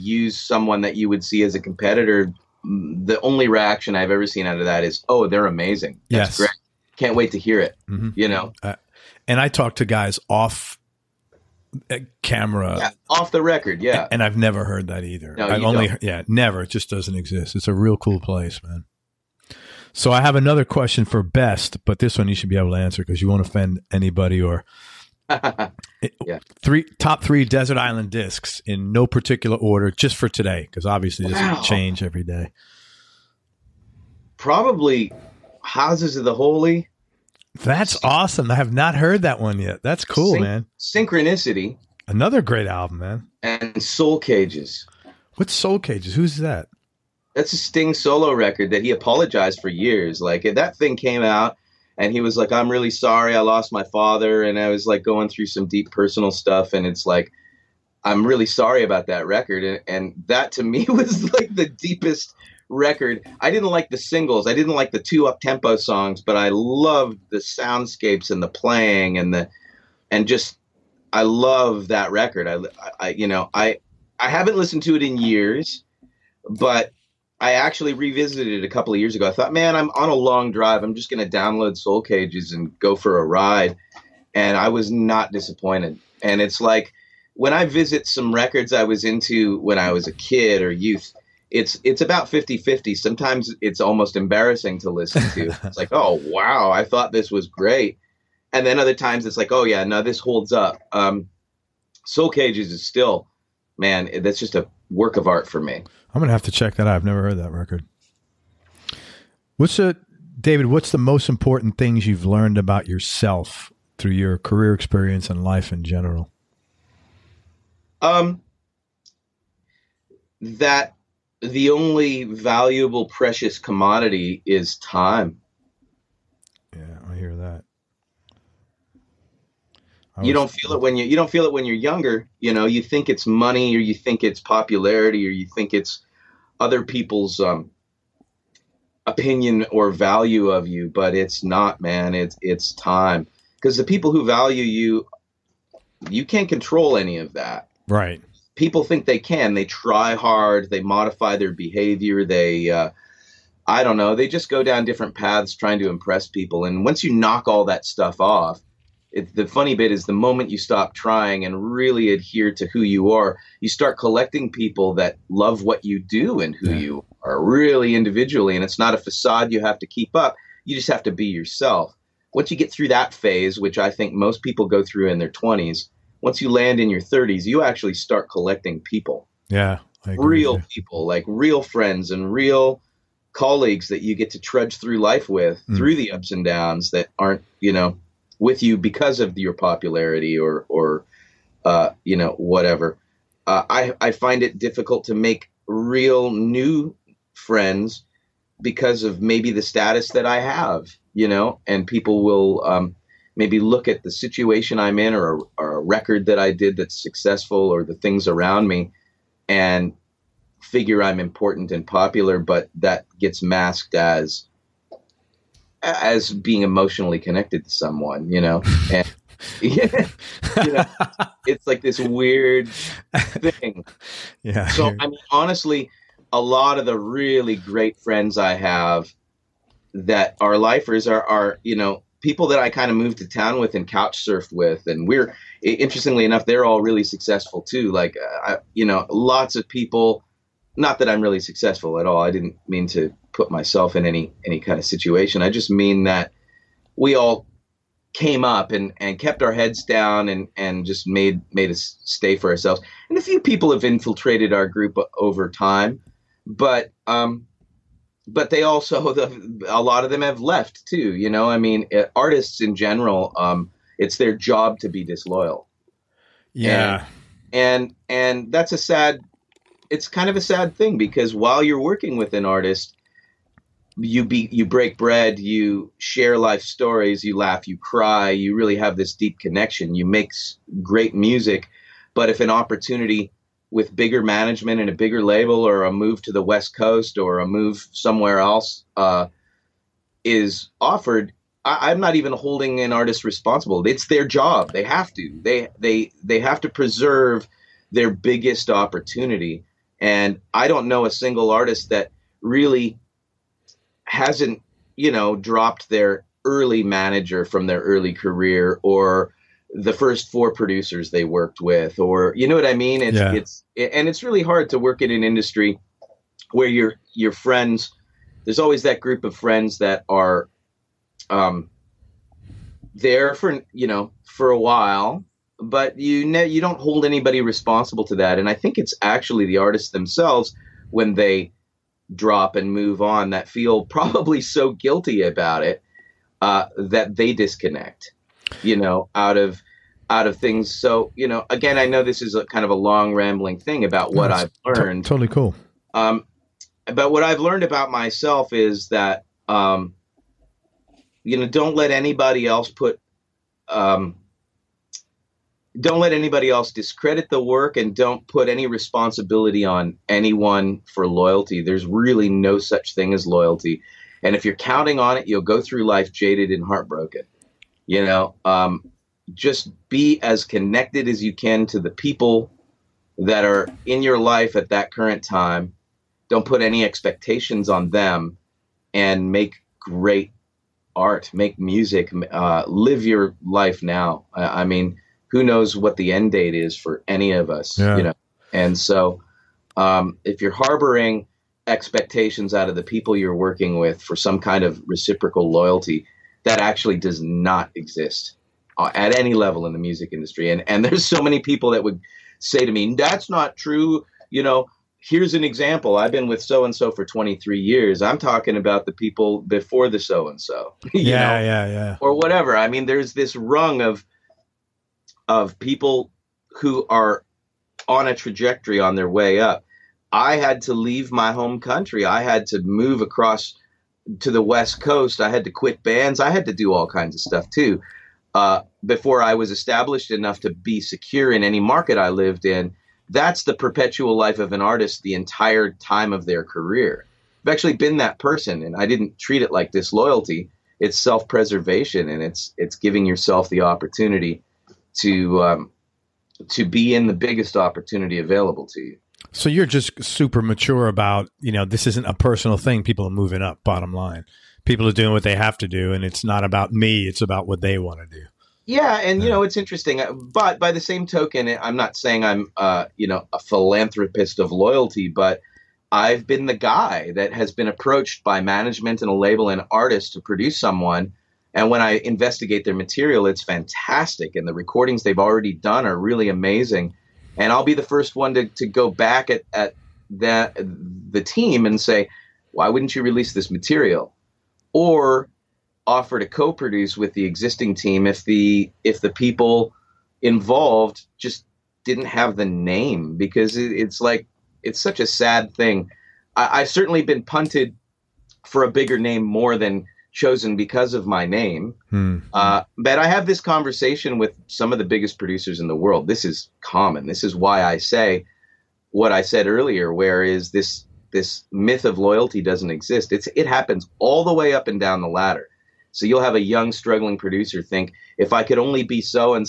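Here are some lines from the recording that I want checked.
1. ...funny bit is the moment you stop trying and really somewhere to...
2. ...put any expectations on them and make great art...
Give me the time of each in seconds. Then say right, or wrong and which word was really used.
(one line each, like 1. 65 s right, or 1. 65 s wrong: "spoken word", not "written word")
1. 159 s wrong: "adhere", not "somewhere"
2. 376 s right.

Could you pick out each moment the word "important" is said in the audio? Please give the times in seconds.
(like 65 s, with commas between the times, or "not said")
111 s, 211 s.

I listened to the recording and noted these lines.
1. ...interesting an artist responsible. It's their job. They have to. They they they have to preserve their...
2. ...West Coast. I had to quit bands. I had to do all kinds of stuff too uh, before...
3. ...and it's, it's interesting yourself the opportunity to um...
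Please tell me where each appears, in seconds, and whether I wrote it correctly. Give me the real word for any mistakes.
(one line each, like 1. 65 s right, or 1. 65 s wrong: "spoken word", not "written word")
1. 292 s wrong: "holding", not "interesting"
2. 424 s right
3. 442 s wrong: "giving", not "interesting".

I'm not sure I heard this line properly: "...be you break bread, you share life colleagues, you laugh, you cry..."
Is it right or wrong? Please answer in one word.
wrong.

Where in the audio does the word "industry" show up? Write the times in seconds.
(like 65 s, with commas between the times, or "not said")
315 s, 400 s.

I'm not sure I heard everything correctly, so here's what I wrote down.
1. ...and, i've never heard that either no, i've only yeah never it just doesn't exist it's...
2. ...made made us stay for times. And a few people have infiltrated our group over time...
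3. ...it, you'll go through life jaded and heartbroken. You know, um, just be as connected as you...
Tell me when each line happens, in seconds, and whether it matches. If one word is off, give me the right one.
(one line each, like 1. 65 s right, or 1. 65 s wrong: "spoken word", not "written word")
1. 14 s right
2. 251 s wrong: "ourselves", not "times"
3. 365 s right.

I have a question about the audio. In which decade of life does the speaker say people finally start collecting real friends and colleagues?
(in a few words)
30s.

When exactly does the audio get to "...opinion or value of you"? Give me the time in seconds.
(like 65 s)
139 s.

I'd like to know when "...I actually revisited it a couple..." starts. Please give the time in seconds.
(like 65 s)
77 s.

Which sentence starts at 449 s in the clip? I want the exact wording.
So you're just super mature about you know this isn't a personal thing.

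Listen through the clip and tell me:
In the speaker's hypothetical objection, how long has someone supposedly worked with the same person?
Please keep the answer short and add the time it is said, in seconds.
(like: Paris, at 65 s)
23 years, at 407 s.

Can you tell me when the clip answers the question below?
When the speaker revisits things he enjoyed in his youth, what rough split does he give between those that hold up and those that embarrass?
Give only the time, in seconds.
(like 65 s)
92 s.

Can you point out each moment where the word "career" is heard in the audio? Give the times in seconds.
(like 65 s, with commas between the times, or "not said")
114 s, 308 s, 436 s.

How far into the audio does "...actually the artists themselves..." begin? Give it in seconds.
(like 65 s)
329 s.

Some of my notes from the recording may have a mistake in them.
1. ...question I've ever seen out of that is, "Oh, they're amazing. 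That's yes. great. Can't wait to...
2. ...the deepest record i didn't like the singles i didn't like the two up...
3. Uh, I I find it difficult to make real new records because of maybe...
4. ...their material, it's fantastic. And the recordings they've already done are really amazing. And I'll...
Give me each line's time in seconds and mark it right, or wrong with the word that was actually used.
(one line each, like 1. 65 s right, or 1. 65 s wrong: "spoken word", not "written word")
1. 3 s wrong: "reaction", not "question"
2. 61 s right
3. 193 s wrong: "friends", not "records"
4. 472 s right.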